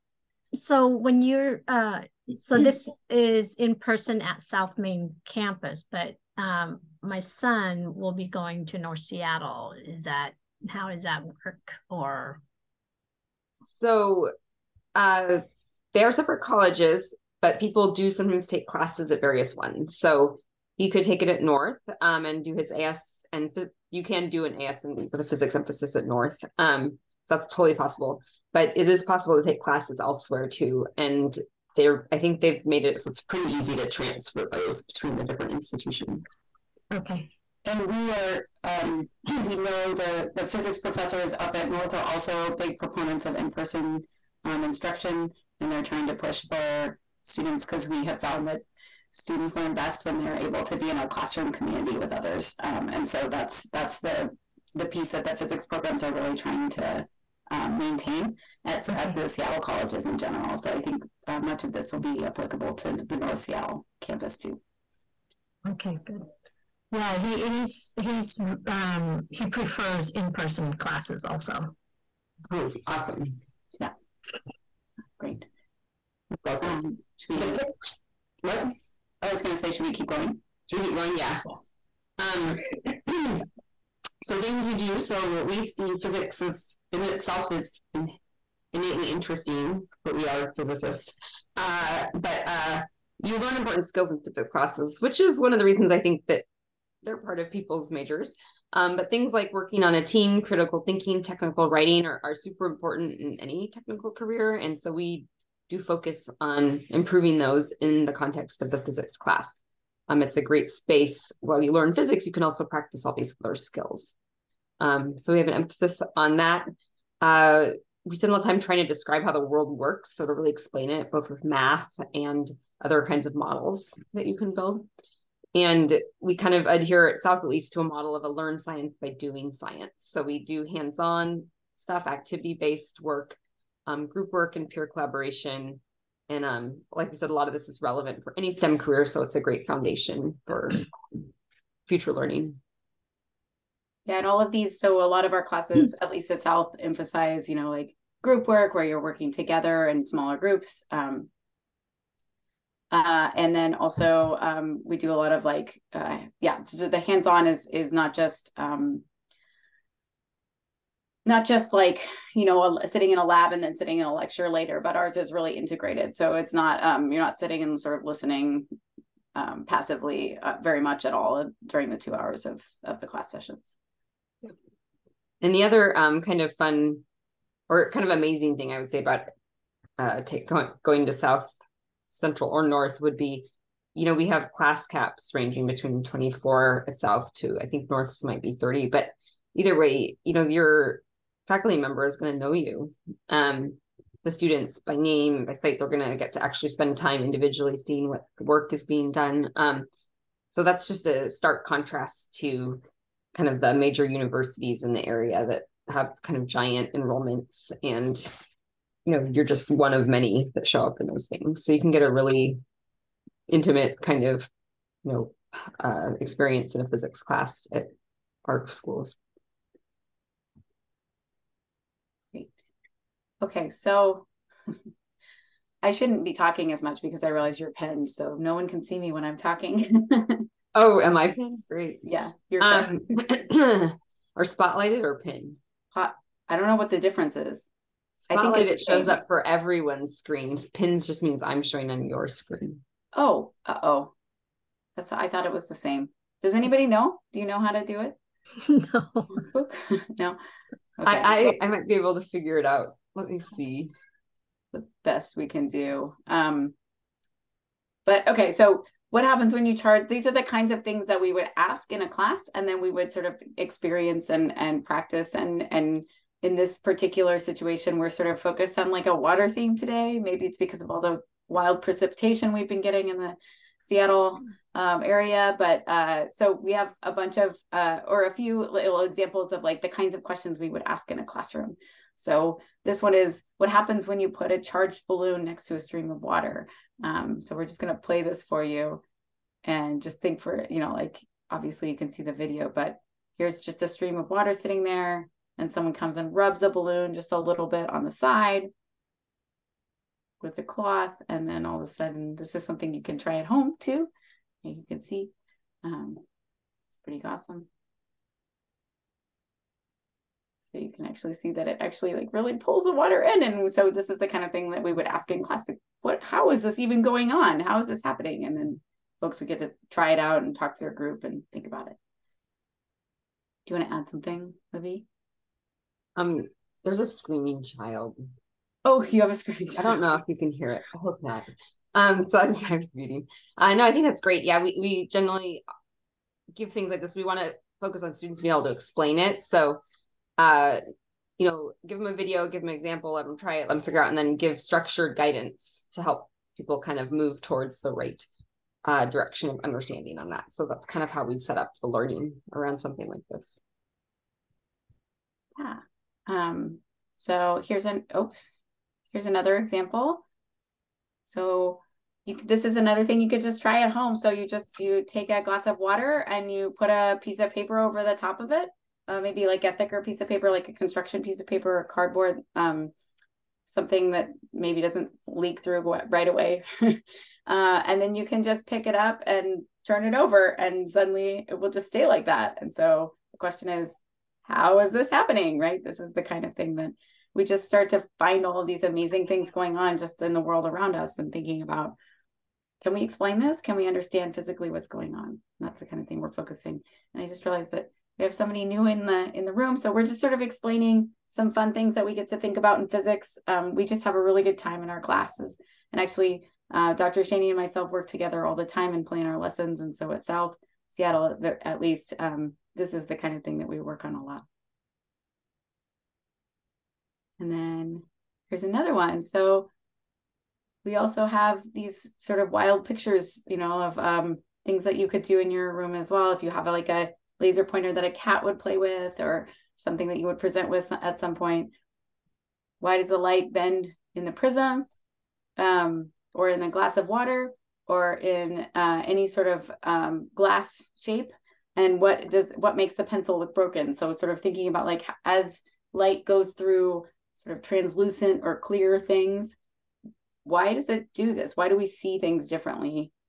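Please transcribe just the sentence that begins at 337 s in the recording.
We want to focus on students being able to explain it.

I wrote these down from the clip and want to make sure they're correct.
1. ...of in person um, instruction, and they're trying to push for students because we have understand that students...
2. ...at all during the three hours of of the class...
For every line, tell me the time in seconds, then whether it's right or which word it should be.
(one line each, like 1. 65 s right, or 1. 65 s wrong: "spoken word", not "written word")
1. 43 s wrong: "found", not "understand"
2. 171 s wrong: "two", not "three".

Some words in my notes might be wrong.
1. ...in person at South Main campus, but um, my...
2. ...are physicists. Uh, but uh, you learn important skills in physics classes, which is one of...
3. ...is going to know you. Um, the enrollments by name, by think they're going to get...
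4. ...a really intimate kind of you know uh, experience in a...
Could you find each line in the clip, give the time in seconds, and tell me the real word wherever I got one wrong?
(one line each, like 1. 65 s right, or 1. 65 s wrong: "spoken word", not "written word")
1. 3 s right
2. 90 s right
3. 192 s wrong: "students", not "enrollments"
4. 212 s right.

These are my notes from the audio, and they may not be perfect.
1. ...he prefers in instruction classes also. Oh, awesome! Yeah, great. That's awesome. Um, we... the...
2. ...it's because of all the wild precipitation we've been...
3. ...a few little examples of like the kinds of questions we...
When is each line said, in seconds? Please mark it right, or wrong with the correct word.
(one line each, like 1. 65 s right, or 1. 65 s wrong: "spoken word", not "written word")
1. 69 s wrong: "person", not "instruction"
2. 270 s right
3. 278 s right.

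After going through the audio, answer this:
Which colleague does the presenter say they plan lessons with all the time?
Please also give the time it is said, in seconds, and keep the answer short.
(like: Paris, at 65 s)
Dr Schoene, at 406 s.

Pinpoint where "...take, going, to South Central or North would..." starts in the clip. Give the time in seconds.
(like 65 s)
180 s.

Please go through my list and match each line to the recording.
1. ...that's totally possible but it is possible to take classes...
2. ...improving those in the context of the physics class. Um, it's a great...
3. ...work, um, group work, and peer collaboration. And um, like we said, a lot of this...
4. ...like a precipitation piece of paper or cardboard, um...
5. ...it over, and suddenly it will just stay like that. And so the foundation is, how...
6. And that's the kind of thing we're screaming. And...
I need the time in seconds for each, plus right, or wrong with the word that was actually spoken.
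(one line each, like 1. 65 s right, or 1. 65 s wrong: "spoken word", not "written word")
1. 27 s right
2. 106 s right
3. 133 s right
4. 370 s wrong: "construction", not "precipitation"
5. 380 s wrong: "question", not "foundation"
6. 395 s wrong: "focusing", not "screaming".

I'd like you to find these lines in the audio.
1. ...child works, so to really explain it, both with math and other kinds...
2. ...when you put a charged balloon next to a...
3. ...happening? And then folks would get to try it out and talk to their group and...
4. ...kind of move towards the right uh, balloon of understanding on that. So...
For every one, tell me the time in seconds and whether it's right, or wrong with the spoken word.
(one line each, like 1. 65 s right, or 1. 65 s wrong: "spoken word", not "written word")
1. 119 s wrong: "world", not "child"
2. 284 s right
3. 318 s right
4. 346 s wrong: "direction", not "balloon".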